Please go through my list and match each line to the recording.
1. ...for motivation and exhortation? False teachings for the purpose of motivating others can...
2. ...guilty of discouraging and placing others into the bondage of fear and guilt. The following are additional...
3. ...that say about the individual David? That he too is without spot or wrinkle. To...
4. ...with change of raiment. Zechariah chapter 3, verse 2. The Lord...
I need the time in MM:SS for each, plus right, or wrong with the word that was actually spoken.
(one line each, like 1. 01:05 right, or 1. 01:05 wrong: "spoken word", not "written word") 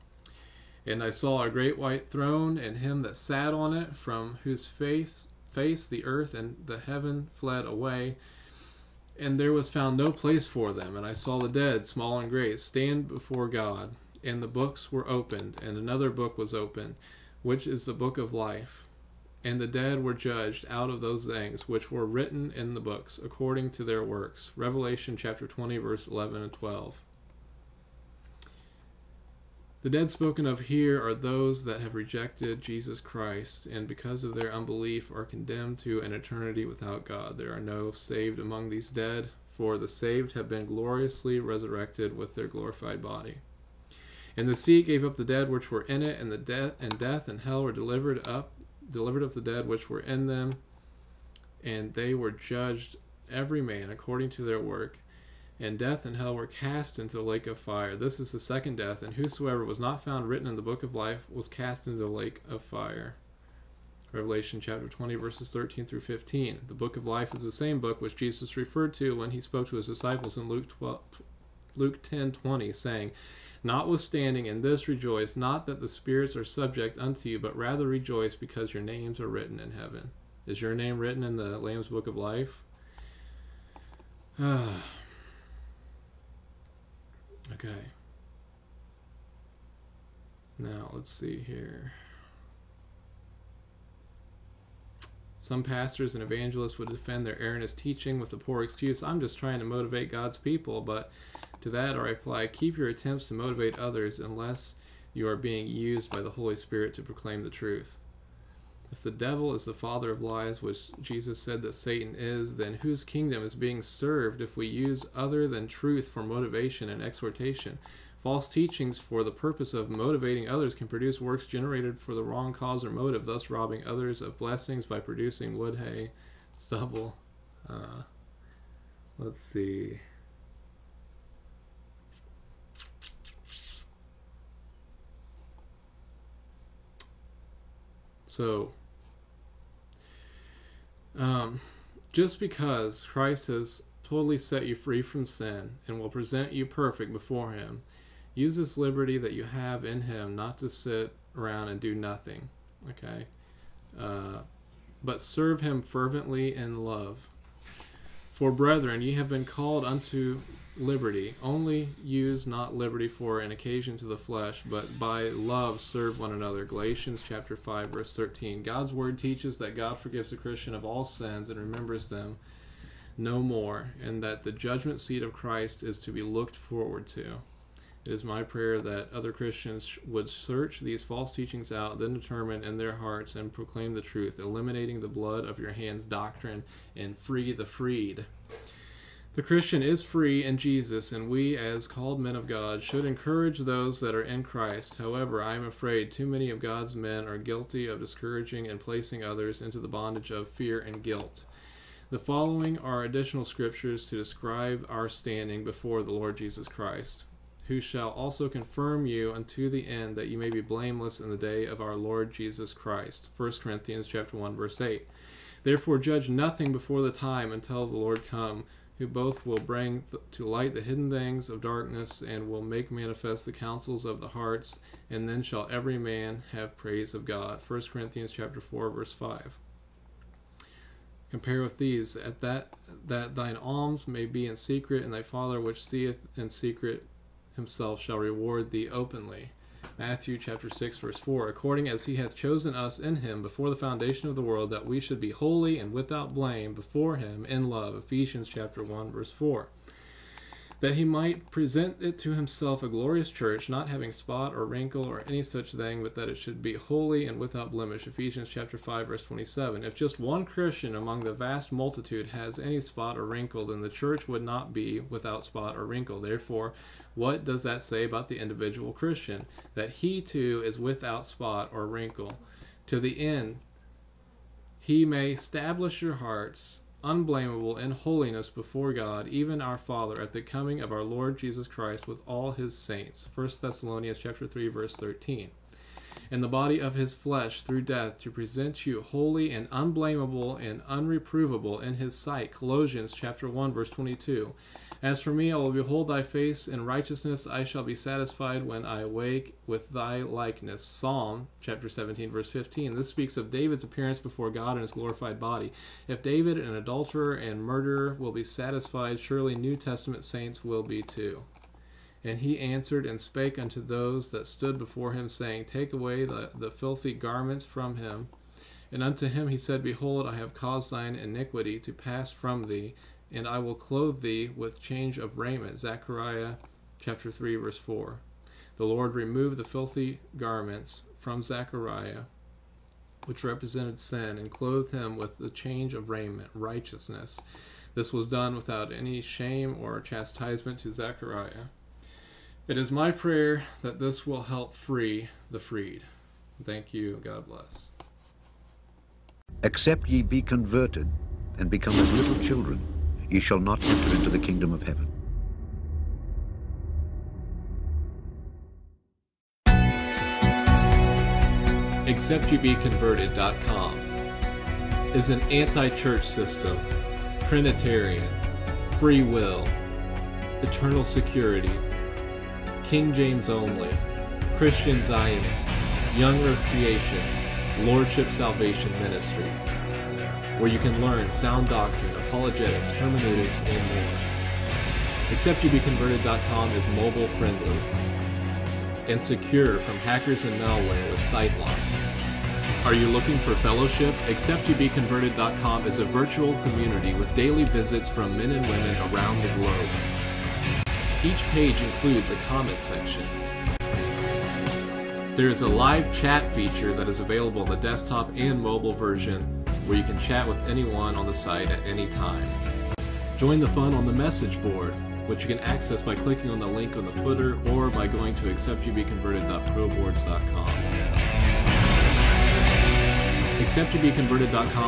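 1. 01:56 right
2. 03:17 right
3. 04:27 wrong: "Christian", not "David"
4. 05:24 wrong: "4", not "2".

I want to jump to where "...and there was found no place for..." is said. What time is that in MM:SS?
00:09.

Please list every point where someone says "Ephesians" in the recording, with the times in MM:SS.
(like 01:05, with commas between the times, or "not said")
04:07, 04:18.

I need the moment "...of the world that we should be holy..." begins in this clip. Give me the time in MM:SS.
04:04.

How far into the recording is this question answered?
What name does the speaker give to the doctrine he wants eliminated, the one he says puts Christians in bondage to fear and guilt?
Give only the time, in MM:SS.
03:05.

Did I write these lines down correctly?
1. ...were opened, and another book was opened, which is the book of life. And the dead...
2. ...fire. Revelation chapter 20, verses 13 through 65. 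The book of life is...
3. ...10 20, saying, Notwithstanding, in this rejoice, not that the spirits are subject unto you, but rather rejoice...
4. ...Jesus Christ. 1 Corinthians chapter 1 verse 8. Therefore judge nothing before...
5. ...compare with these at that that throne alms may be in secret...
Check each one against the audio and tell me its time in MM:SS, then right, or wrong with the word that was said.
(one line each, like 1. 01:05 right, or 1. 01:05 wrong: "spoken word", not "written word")
1. 00:14 right
2. 01:02 wrong: "15", not "65"
3. 01:12 right
4. 03:32 right
5. 03:51 wrong: "thine", not "throne".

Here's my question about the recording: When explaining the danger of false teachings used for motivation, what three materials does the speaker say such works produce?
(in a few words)
wood, hay, stubble.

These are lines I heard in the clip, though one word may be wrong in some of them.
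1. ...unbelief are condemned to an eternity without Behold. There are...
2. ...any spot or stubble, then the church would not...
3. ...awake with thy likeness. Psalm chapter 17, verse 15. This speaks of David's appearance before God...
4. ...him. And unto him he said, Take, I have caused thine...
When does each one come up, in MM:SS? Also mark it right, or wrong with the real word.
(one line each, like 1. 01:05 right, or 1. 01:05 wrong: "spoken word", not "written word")
1. 00:34 wrong: "God", not "Behold"
2. 04:22 wrong: "wrinkle", not "stubble"
3. 04:59 right
4. 05:17 wrong: "Behold", not "Take".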